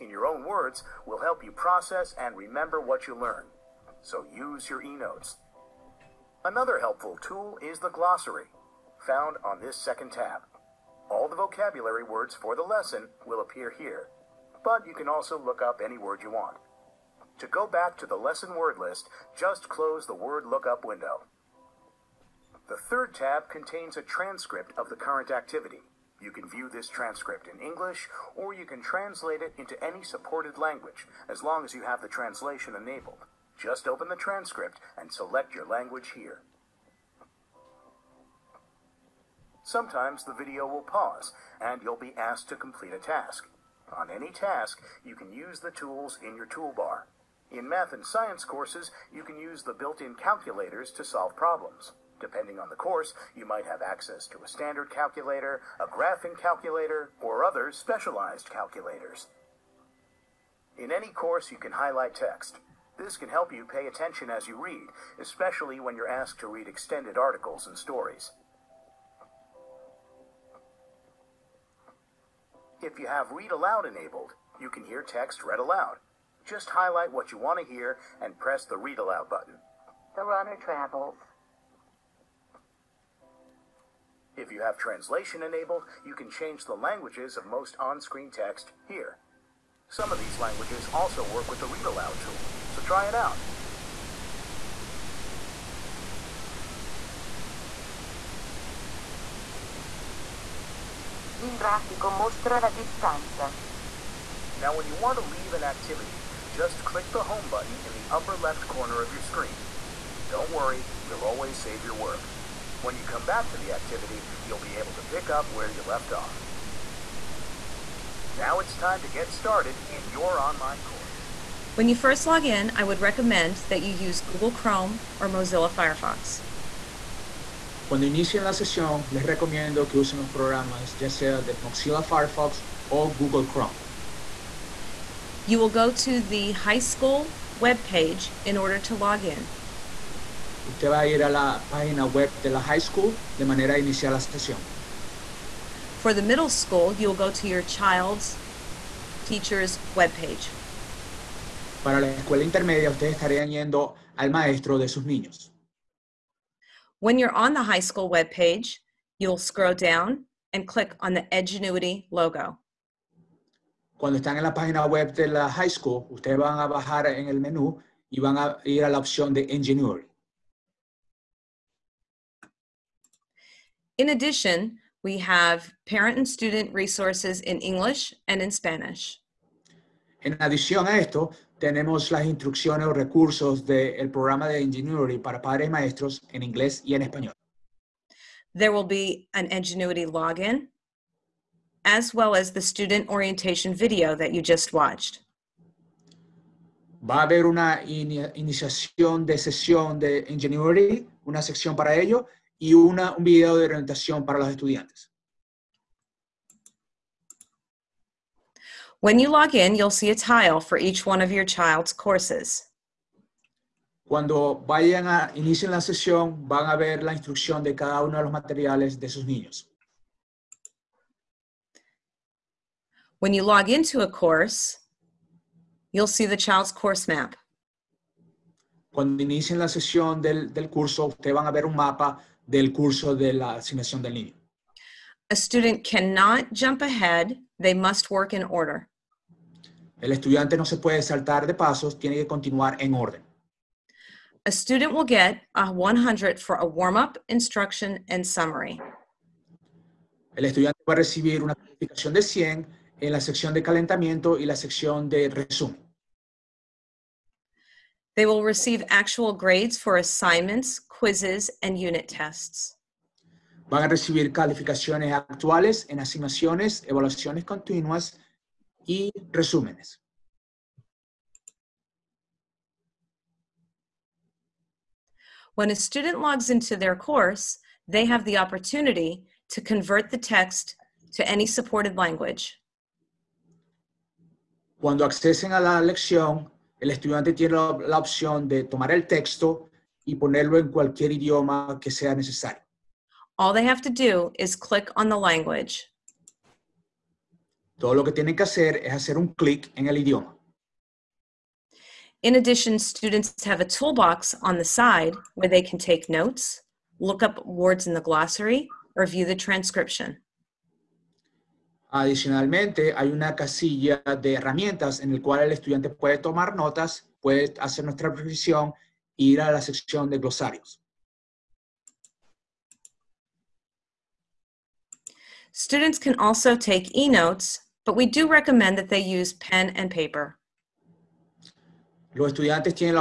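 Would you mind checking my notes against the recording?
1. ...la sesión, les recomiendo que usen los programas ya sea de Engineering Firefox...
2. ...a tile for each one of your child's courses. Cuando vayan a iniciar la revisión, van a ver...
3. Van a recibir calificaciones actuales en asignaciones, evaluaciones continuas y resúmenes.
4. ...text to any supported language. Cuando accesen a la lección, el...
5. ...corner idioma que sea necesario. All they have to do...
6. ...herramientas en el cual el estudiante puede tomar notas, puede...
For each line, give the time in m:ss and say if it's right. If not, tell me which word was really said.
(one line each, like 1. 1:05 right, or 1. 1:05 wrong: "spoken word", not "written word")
1. 2:08 wrong: "Mozilla", not "Engineering"
2. 3:30 wrong: "sesión", not "revisión"
3. 4:23 right
4. 4:40 right
5. 4:50 wrong: "cualquier", not "corner"
6. 5:14 right.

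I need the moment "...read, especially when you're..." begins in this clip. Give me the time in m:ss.
1:04.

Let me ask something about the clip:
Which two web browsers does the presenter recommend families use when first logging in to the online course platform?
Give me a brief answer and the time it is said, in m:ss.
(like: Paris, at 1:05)
Google Chrome or Mozilla Firefox, at 2:04.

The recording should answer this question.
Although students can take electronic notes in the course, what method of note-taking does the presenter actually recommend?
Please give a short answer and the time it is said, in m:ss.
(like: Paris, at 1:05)
Pen and paper, at 5:29.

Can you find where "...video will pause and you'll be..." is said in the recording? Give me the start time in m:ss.
0:40.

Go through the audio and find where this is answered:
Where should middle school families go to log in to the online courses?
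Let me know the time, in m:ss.
2:27.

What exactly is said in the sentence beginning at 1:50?
Don't worry, we'll always save your work.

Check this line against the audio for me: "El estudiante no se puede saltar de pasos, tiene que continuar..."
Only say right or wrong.
right.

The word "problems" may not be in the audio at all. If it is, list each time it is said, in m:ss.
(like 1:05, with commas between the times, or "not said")
0:51.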